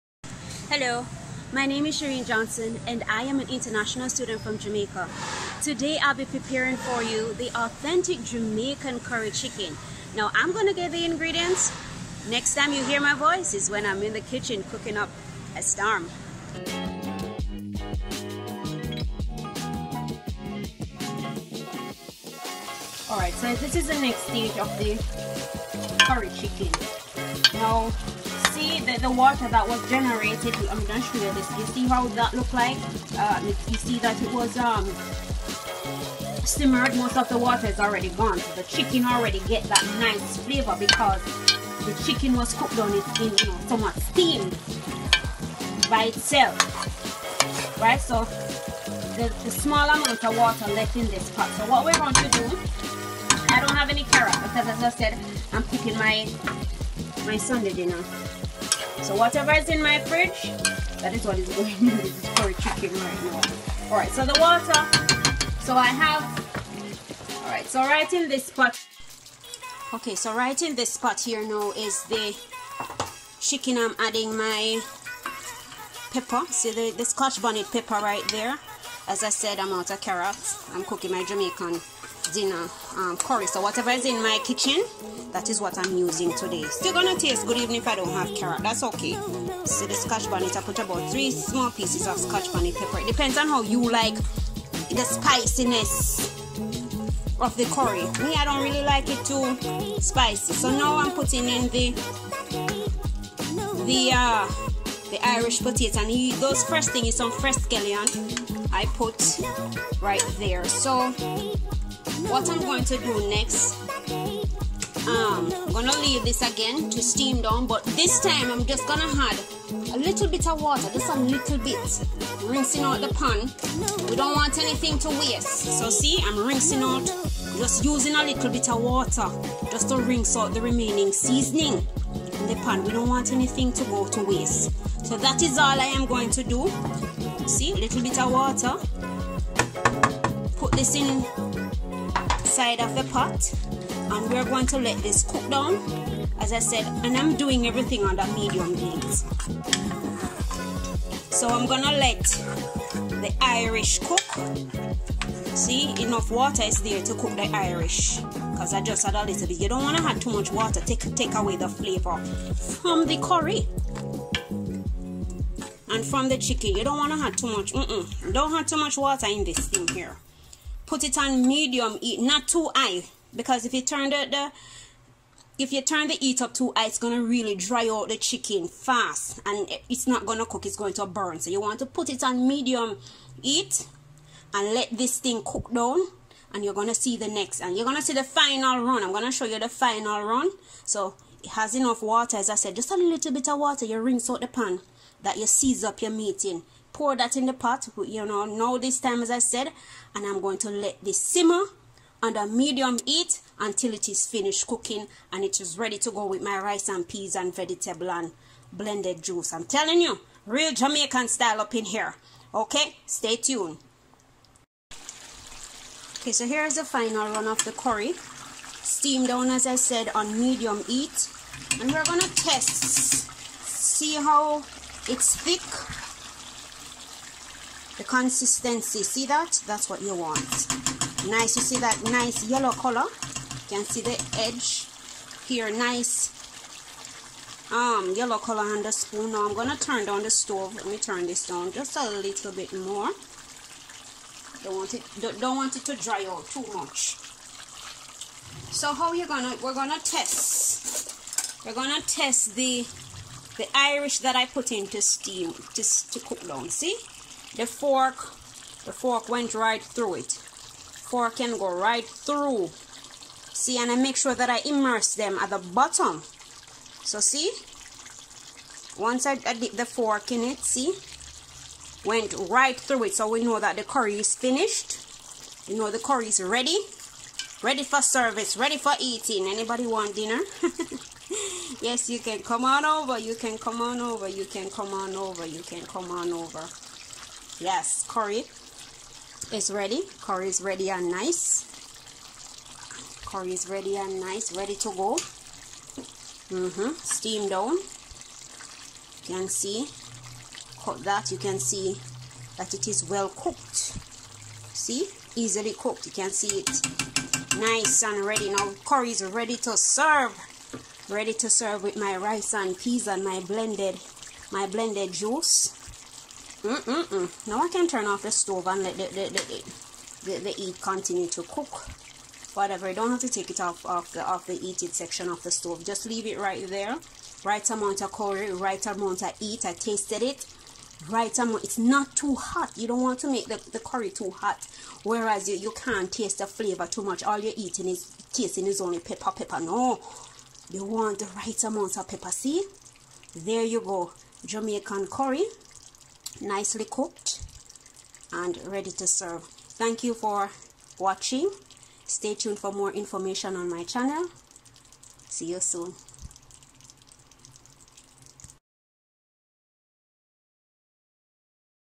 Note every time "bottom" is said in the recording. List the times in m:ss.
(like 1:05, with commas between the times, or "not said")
4:25.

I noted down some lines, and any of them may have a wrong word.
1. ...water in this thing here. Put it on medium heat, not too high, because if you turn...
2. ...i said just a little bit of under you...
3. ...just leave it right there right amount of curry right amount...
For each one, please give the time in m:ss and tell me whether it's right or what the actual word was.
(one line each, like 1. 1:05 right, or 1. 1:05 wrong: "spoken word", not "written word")
1. 2:48 right
2. 3:12 wrong: "water", not "under"
3. 5:25 right.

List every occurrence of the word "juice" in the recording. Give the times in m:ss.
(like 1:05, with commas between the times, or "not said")
3:29, 5:15.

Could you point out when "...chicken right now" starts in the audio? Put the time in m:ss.
1:02.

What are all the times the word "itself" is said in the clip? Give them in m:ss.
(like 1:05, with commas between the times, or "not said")
0:46.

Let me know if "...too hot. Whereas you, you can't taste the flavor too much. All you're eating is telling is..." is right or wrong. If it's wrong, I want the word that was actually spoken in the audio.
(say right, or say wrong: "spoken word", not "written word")
wrong: "tasting", not "telling".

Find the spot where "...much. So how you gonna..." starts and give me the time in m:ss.
4:06.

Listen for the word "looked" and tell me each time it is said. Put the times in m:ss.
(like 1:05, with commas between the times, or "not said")
0:32.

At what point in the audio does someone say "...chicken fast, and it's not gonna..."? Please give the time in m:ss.
2:58.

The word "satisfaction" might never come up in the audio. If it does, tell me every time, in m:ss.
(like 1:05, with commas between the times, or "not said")
not said.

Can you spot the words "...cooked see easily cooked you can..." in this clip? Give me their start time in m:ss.
5:03.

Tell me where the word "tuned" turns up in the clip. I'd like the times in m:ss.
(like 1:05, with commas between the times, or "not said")
3:33, 5:52.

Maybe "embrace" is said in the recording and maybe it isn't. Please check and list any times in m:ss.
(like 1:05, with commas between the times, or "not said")
not said.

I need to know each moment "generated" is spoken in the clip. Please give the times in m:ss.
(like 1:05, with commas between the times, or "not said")
0:29.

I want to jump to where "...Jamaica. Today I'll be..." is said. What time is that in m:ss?
0:04.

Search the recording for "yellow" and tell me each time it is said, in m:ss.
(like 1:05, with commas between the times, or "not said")
3:52, 3:58.